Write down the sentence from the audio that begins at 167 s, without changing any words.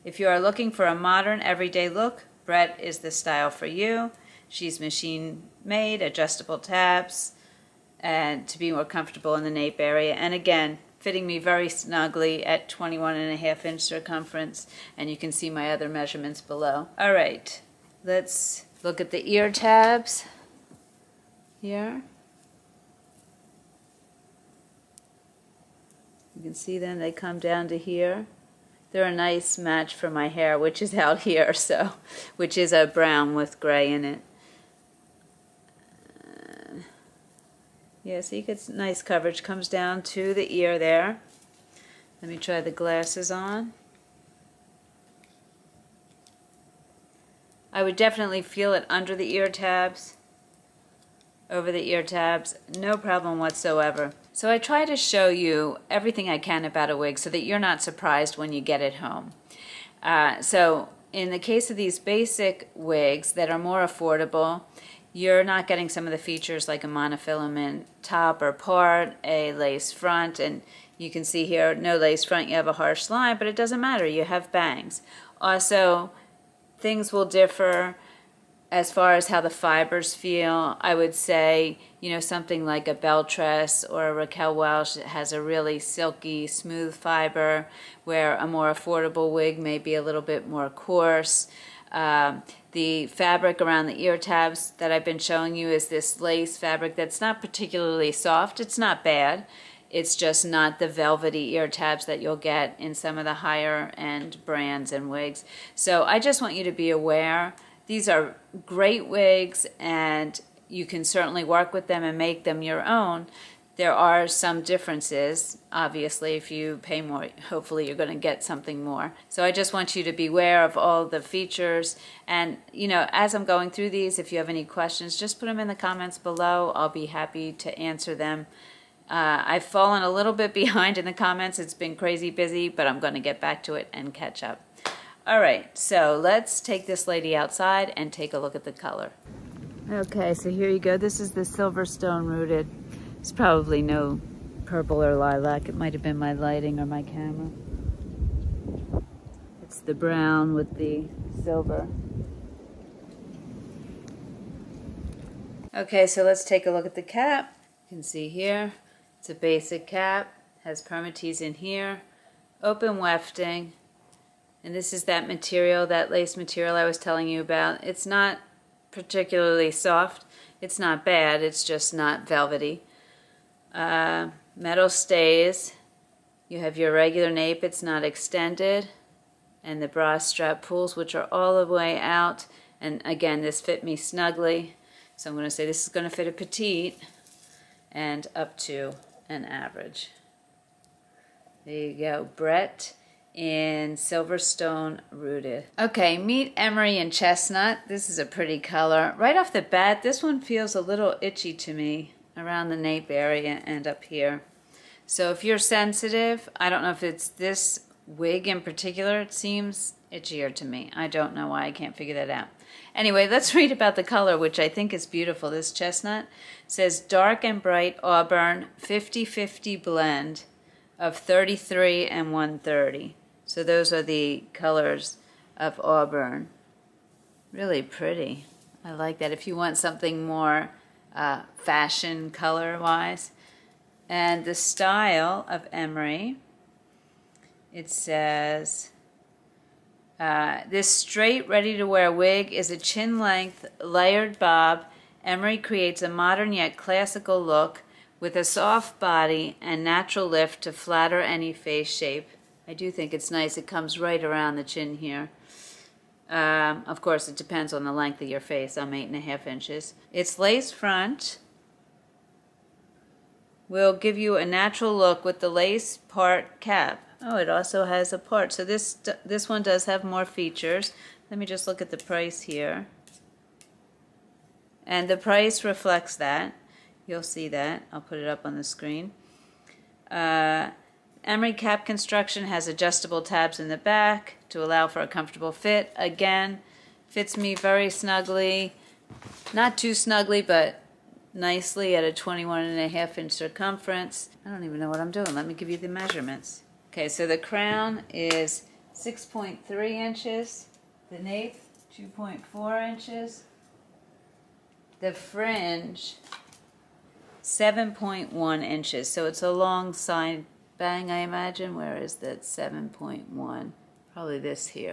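It's not particularly soft, it's not bad, it's just not velvety uh, metal stays.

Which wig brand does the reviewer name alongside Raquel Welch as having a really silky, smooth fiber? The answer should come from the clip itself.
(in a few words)
BelleTress.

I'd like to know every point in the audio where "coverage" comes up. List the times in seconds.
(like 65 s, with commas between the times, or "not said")
39 s.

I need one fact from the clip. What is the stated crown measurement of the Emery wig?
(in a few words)
6.3 inches.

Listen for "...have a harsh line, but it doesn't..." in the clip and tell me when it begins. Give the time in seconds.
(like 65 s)
72 s.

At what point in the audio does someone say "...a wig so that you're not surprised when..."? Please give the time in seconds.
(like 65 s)
56 s.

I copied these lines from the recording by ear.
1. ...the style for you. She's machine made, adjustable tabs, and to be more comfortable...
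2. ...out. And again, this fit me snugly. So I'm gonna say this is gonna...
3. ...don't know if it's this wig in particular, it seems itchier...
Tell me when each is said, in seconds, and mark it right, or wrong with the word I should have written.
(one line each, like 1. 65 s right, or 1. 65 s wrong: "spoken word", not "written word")
1. 2 s right
2. 182 s right
3. 206 s right.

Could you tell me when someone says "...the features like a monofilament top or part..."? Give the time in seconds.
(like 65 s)
66 s.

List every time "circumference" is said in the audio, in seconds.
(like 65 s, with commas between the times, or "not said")
13 s, 293 s.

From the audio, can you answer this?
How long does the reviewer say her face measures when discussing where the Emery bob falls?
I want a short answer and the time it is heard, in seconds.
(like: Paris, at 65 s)
8.5 inches, at 258 s.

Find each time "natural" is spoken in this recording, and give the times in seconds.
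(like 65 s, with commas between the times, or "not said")
249 s, 264 s.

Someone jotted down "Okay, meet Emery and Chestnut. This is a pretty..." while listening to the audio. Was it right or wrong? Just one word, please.
right.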